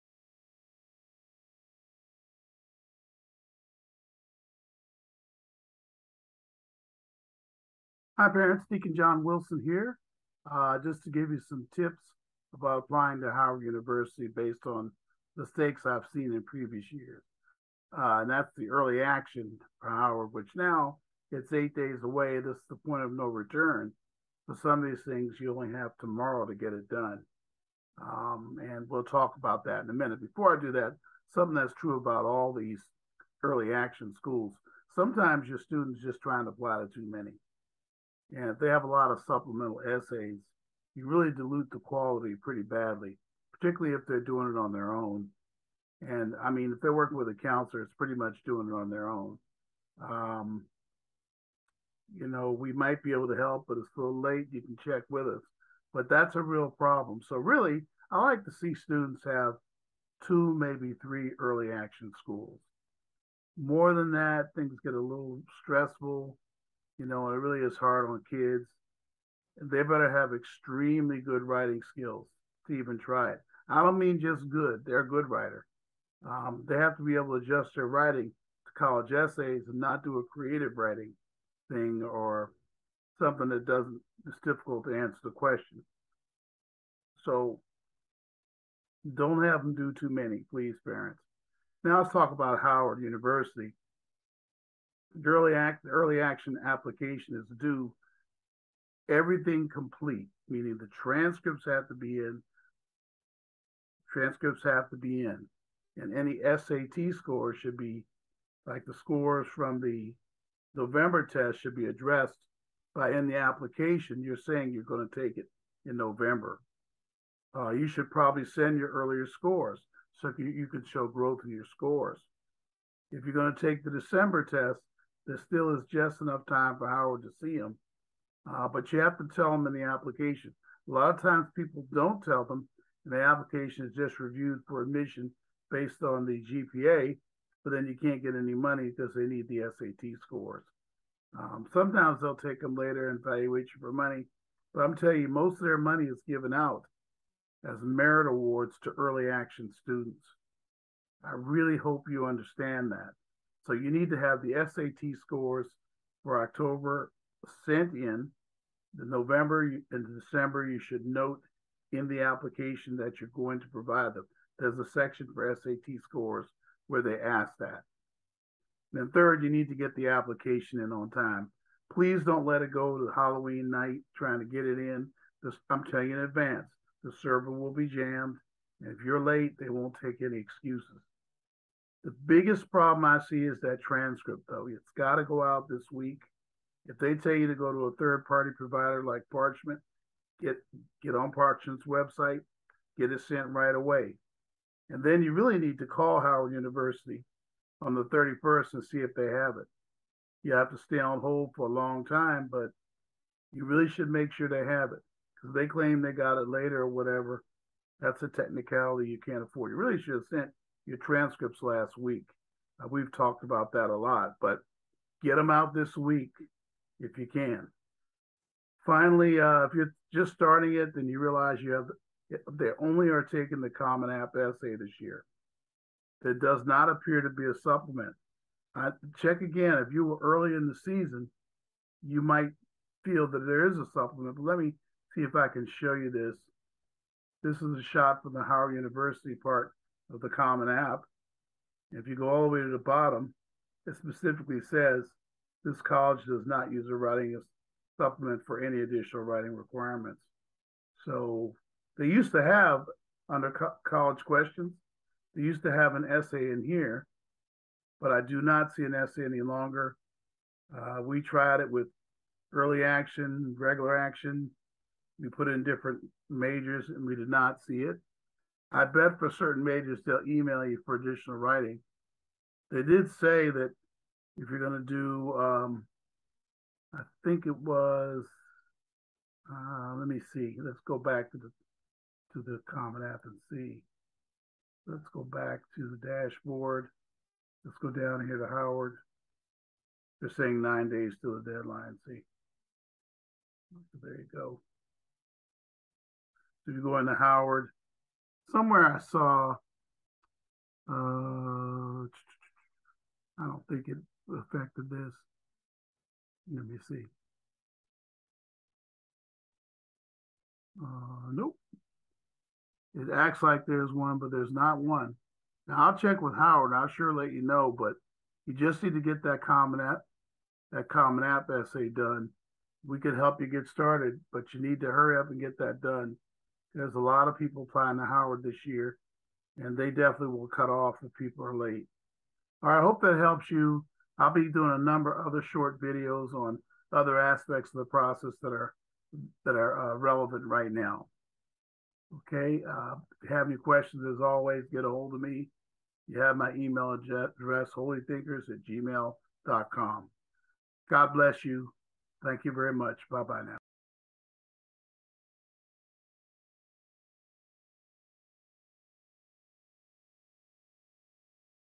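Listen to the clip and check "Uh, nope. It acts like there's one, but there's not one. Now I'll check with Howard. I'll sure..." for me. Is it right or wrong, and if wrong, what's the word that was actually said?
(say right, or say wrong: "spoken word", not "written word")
right.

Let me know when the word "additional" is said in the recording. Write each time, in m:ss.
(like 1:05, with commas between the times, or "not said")
4:08, 4:30.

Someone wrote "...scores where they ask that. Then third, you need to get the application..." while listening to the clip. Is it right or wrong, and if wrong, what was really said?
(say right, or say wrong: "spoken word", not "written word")
right.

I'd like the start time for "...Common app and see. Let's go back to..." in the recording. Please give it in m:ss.
4:42.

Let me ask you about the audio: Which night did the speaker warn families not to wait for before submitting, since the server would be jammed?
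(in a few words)
Halloween.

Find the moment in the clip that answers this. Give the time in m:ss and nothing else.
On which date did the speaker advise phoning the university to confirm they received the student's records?
3:17.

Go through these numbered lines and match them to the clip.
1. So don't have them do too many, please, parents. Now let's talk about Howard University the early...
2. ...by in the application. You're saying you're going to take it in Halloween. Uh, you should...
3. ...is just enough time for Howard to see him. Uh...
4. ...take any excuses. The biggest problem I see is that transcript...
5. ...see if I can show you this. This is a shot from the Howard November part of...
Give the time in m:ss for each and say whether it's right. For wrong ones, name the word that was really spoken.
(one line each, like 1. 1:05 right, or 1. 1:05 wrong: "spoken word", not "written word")
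1. 1:27 right
2. 1:52 wrong: "November", not "Halloween"
3. 2:05 right
4. 3:00 right
5. 3:55 wrong: "University", not "November".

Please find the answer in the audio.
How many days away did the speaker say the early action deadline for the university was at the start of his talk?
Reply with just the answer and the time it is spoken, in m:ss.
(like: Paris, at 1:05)
8, at 0:21.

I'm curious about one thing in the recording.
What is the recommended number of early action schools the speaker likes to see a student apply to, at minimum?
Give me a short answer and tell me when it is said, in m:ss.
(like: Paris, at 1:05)
2, at 1:00.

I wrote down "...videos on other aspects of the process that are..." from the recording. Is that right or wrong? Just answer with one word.
right.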